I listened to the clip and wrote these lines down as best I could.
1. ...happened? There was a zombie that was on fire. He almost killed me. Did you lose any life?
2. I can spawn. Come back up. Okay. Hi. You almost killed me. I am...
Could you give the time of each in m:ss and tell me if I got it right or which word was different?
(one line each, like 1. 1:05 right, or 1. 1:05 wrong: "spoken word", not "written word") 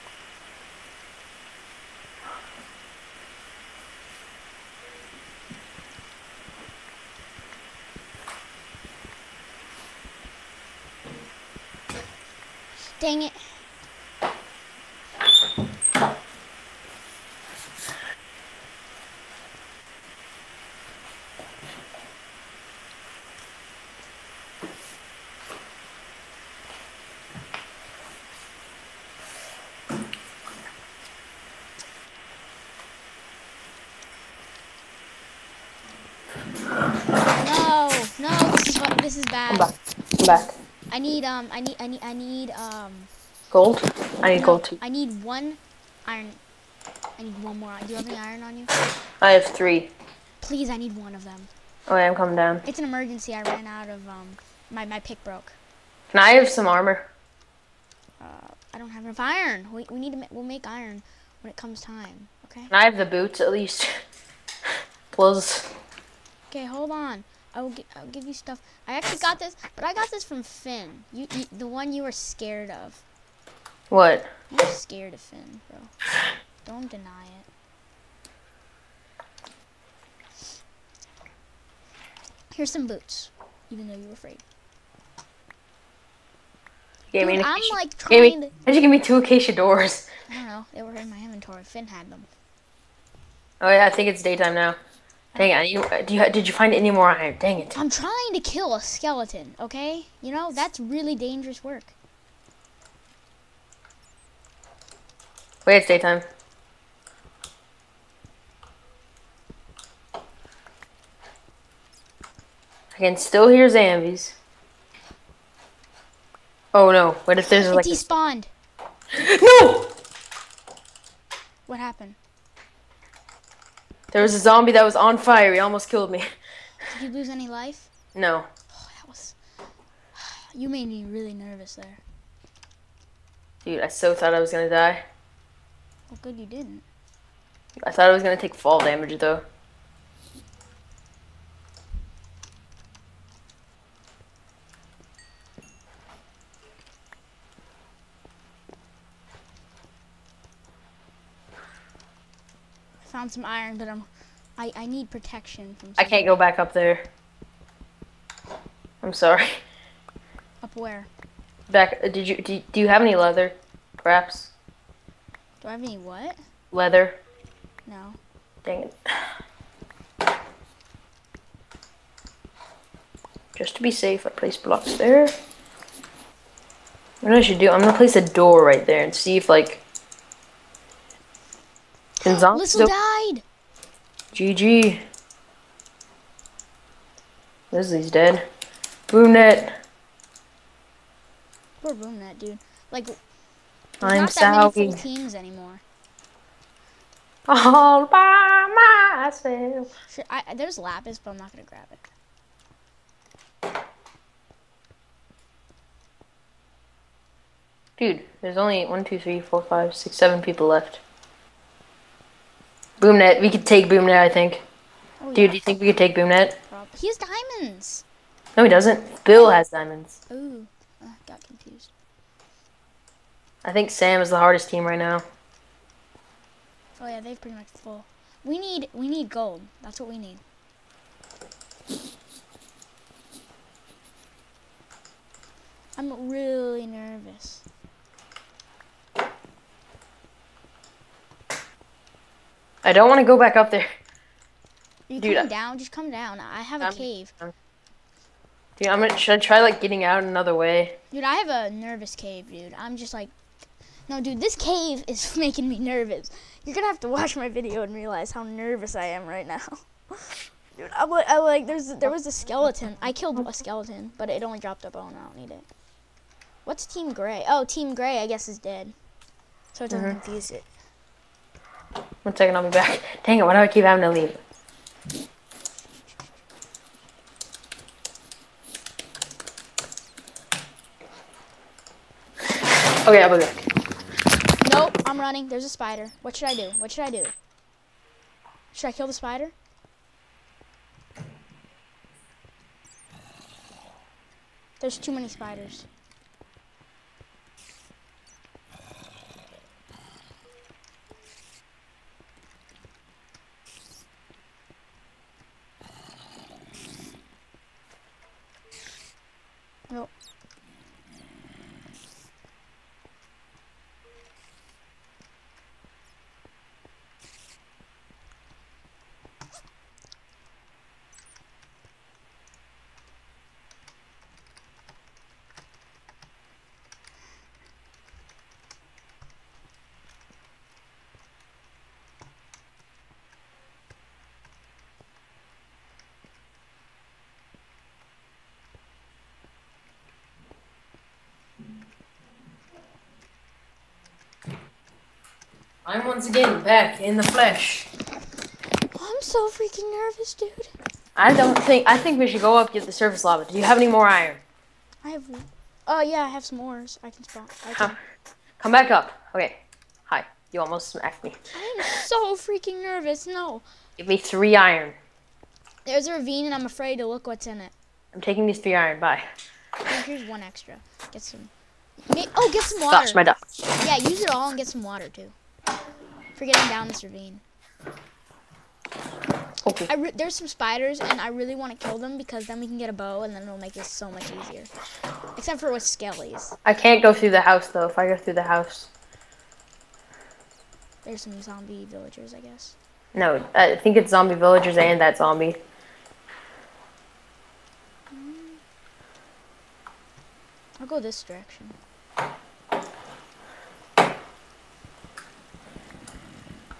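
1. 2:01 right
2. 5:57 wrong: "smacked", not "killed".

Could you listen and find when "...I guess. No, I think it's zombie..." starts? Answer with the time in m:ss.
6:32.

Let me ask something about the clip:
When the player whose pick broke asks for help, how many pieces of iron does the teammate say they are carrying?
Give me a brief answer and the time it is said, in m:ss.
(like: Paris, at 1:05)
3, at 0:49.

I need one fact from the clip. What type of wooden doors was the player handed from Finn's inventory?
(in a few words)
Acacia doors.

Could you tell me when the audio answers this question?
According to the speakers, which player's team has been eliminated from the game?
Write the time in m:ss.
3:07.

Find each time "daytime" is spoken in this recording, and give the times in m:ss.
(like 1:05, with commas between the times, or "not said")
1:34, 1:45.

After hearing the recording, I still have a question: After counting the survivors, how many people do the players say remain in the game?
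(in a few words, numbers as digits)
7.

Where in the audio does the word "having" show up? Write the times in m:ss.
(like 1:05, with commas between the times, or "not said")
4:33.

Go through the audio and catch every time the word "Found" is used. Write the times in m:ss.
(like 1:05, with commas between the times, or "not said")
2:33.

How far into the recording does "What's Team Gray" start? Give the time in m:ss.
4:26.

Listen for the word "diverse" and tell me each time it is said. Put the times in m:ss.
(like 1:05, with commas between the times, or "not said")
not said.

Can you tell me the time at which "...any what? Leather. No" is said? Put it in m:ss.
2:45.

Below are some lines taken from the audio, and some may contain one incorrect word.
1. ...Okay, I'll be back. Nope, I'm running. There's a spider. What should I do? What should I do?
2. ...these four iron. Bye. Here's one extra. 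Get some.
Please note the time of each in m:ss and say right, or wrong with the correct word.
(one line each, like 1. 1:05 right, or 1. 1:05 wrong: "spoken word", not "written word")
1. 4:43 right
2. 6:08 wrong: "three", not "four".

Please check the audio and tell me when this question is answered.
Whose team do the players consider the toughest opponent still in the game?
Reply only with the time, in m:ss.
3:43.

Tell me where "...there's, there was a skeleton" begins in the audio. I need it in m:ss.
4:21.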